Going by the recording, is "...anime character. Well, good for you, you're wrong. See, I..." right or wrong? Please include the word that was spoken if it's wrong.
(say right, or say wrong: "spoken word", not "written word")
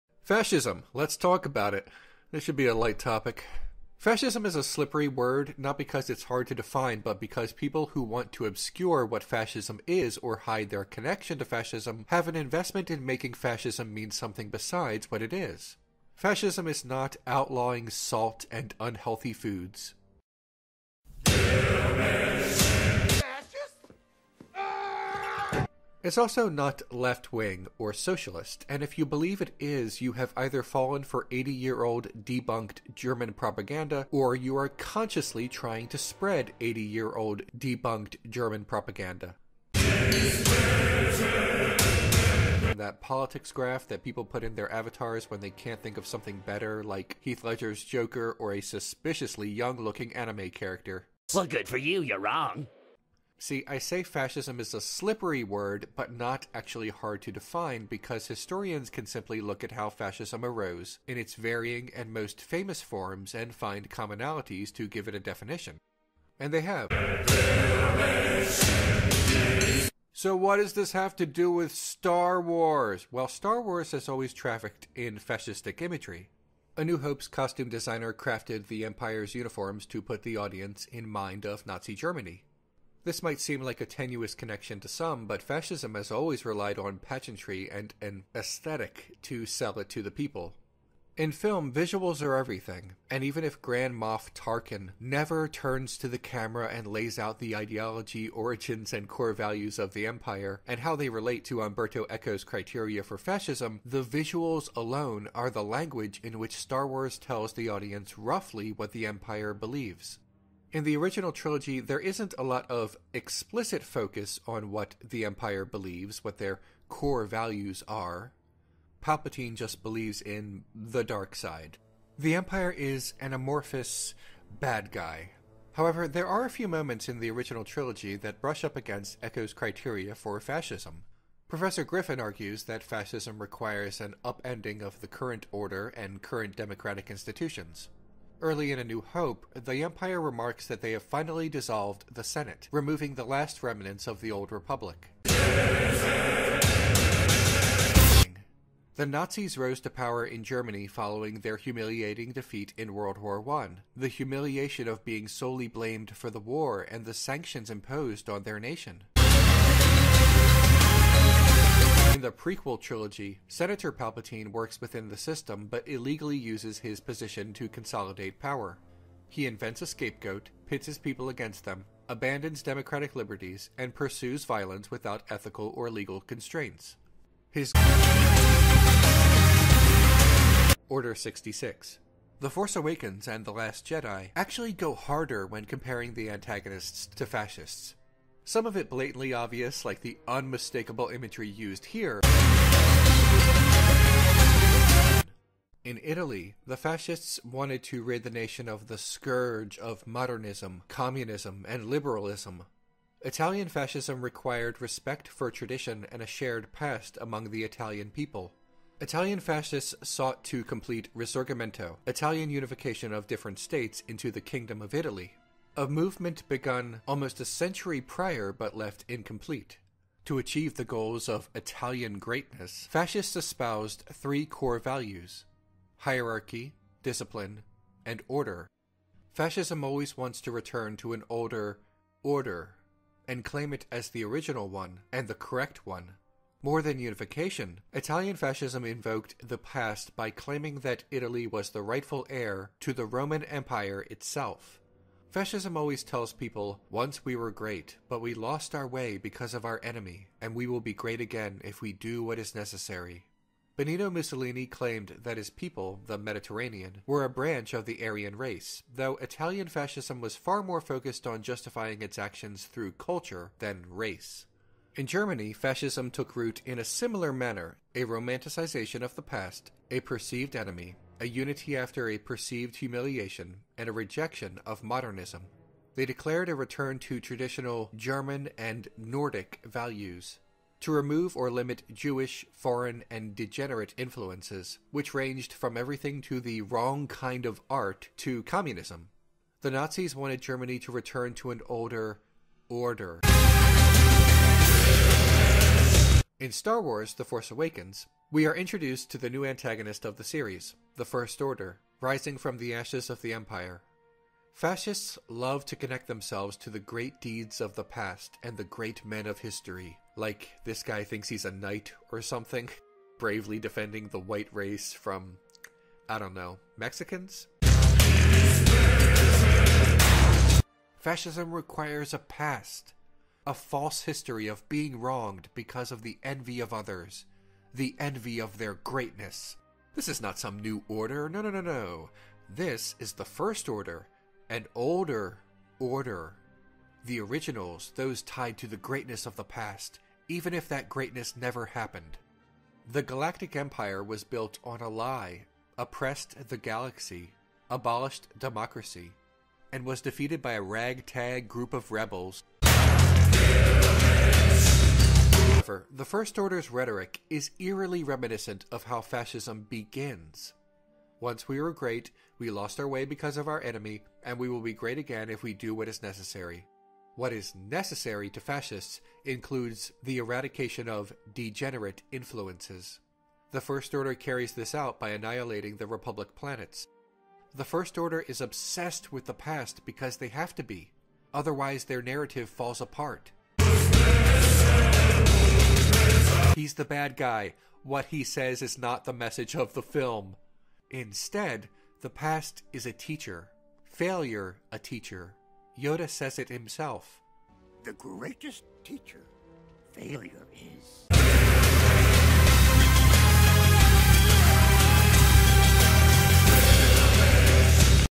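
right.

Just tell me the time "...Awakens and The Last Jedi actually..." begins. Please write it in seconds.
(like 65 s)
182 s.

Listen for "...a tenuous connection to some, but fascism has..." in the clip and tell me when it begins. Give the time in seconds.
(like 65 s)
83 s.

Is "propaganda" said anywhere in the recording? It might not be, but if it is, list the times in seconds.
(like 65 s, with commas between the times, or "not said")
33 s, 38 s.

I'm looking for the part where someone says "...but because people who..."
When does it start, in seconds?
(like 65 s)
7 s.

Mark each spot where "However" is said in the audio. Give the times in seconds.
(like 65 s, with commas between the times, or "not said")
125 s, 355 s.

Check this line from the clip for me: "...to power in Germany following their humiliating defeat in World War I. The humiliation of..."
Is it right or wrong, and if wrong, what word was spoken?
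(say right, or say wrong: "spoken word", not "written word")
right.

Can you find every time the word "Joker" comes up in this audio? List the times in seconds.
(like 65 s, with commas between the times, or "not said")
47 s.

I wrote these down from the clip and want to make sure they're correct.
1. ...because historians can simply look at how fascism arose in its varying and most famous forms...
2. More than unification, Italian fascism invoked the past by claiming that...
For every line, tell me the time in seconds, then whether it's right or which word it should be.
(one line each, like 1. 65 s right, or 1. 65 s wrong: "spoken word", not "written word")
1. 57 s right
2. 236 s right.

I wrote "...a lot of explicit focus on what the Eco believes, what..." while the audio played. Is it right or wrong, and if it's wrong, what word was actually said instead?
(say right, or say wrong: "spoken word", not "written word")
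wrong: "Empire", not "Eco".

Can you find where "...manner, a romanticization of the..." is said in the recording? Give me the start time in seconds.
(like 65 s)
267 s.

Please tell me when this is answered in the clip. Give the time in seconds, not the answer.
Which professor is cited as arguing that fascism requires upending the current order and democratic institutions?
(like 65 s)
131 s.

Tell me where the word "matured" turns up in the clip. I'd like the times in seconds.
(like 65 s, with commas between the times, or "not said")
not said.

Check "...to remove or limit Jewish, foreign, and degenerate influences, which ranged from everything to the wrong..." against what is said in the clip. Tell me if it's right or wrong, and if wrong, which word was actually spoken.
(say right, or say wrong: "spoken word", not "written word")
right.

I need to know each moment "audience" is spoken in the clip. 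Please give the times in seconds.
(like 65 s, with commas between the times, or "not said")
80 s, 107 s.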